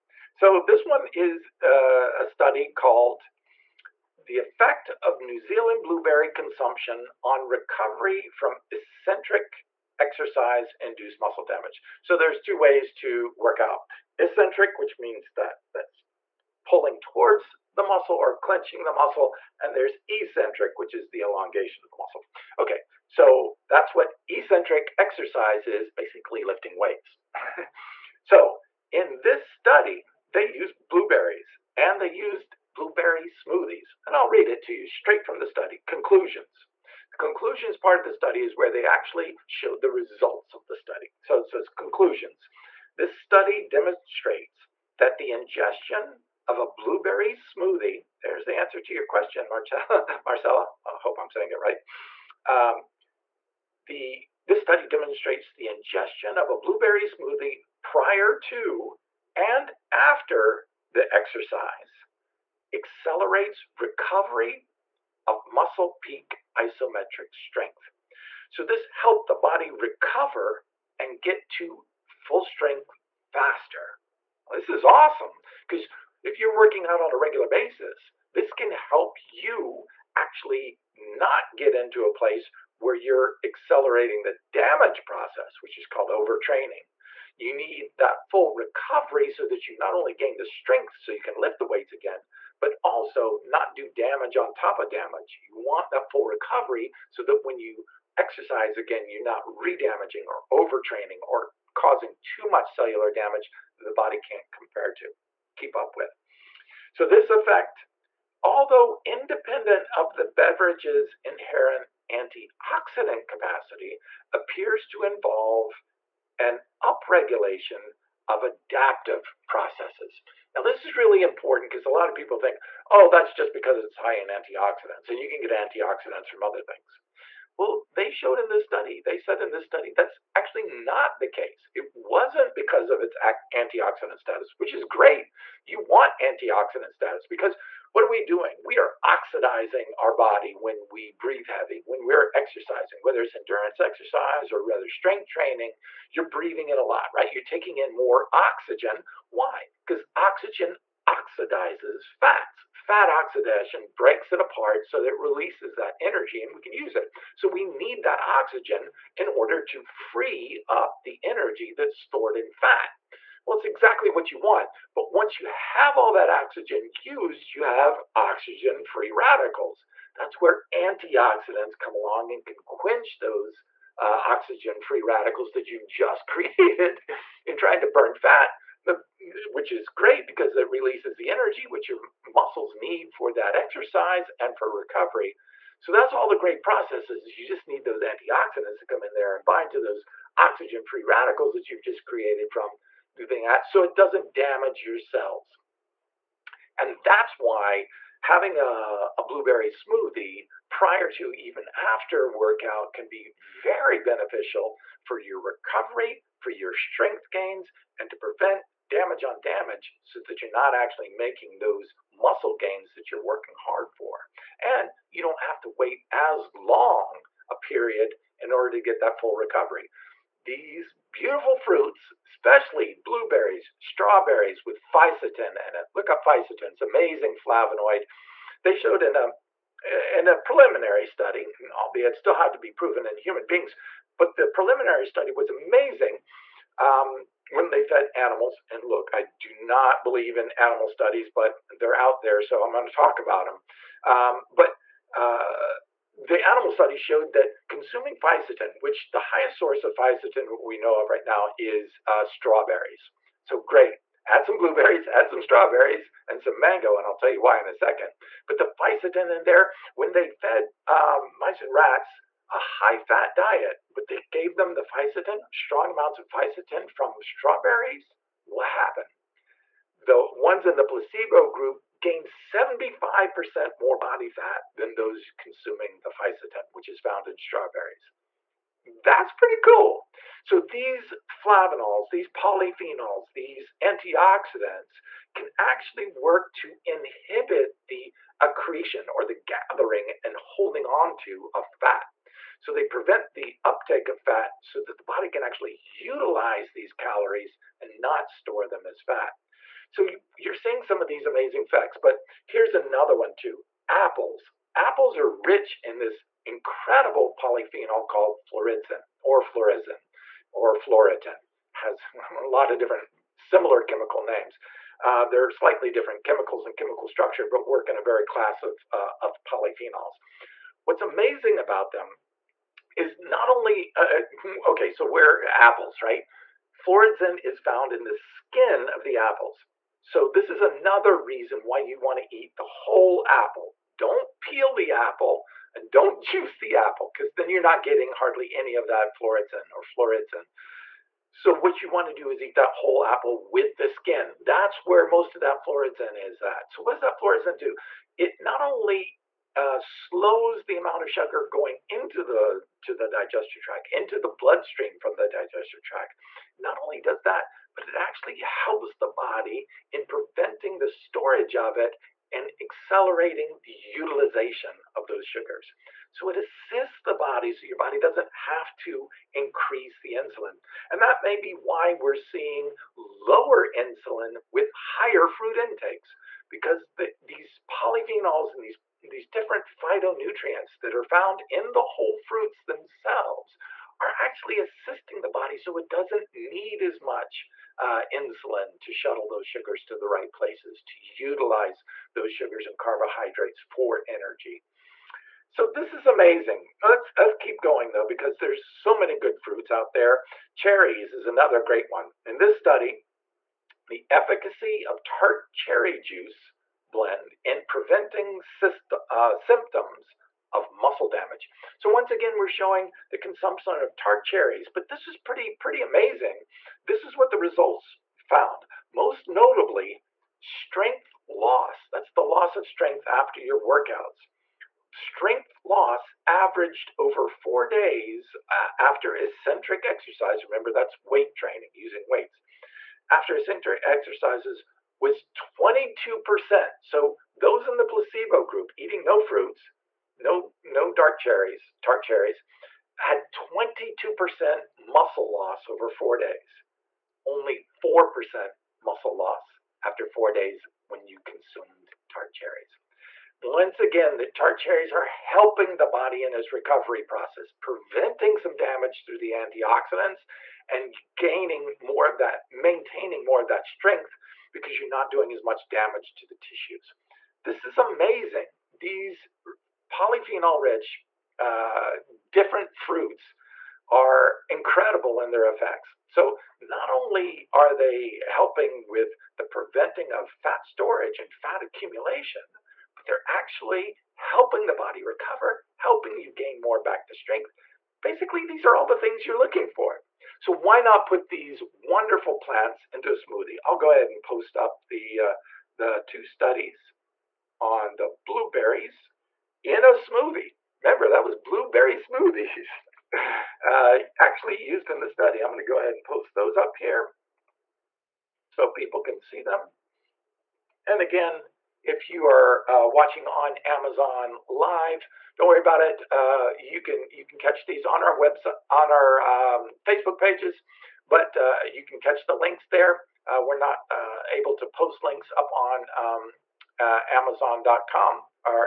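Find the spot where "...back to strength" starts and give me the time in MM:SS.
08:06.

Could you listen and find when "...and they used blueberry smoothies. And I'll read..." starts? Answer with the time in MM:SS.
00:31.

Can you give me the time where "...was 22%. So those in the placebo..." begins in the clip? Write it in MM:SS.
07:15.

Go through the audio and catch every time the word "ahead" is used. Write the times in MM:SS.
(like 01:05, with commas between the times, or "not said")
08:13, 08:25.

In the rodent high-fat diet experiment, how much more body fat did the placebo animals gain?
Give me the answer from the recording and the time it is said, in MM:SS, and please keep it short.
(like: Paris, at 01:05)
75%, at 04:32.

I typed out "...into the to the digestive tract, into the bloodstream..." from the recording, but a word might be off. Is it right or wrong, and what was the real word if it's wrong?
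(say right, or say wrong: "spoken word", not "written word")
right.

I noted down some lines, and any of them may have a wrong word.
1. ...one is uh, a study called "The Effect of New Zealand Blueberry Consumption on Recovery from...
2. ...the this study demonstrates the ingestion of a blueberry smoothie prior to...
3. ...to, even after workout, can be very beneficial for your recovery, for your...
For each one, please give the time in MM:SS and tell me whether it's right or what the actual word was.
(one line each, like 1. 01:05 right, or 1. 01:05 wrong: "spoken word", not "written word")
1. 00:00 right
2. 00:53 right
3. 03:21 right.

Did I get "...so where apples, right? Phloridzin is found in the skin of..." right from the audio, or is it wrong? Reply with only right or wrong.
right.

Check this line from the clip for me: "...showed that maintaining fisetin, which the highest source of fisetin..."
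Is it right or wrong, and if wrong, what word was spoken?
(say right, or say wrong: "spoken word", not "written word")
wrong: "consuming", not "maintaining".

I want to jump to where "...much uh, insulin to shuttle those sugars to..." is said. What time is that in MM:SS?
06:27.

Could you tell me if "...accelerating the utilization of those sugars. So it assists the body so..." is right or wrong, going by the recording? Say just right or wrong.
right.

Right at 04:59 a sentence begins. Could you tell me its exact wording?
So you're seeing some of these amazing facts, but here's another one too apples.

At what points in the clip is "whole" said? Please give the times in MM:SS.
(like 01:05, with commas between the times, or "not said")
05:32, 05:42, 06:21.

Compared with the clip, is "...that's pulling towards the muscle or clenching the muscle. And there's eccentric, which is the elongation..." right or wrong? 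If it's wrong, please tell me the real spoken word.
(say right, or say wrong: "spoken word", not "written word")
right.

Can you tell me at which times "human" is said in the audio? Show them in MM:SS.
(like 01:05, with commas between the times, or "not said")
03:53.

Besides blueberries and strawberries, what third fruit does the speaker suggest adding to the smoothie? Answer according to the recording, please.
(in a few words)
mango.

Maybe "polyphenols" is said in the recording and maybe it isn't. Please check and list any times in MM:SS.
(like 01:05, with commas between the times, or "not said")
04:42, 05:07, 05:19, 06:17, 07:49.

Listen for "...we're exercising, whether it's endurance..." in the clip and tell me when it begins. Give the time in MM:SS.
02:22.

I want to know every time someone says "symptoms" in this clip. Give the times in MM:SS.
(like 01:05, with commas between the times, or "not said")
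06:49.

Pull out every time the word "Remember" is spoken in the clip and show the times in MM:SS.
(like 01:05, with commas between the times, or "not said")
07:10, 08:20.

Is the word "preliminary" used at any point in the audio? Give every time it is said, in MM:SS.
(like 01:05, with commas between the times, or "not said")
03:50, 03:54.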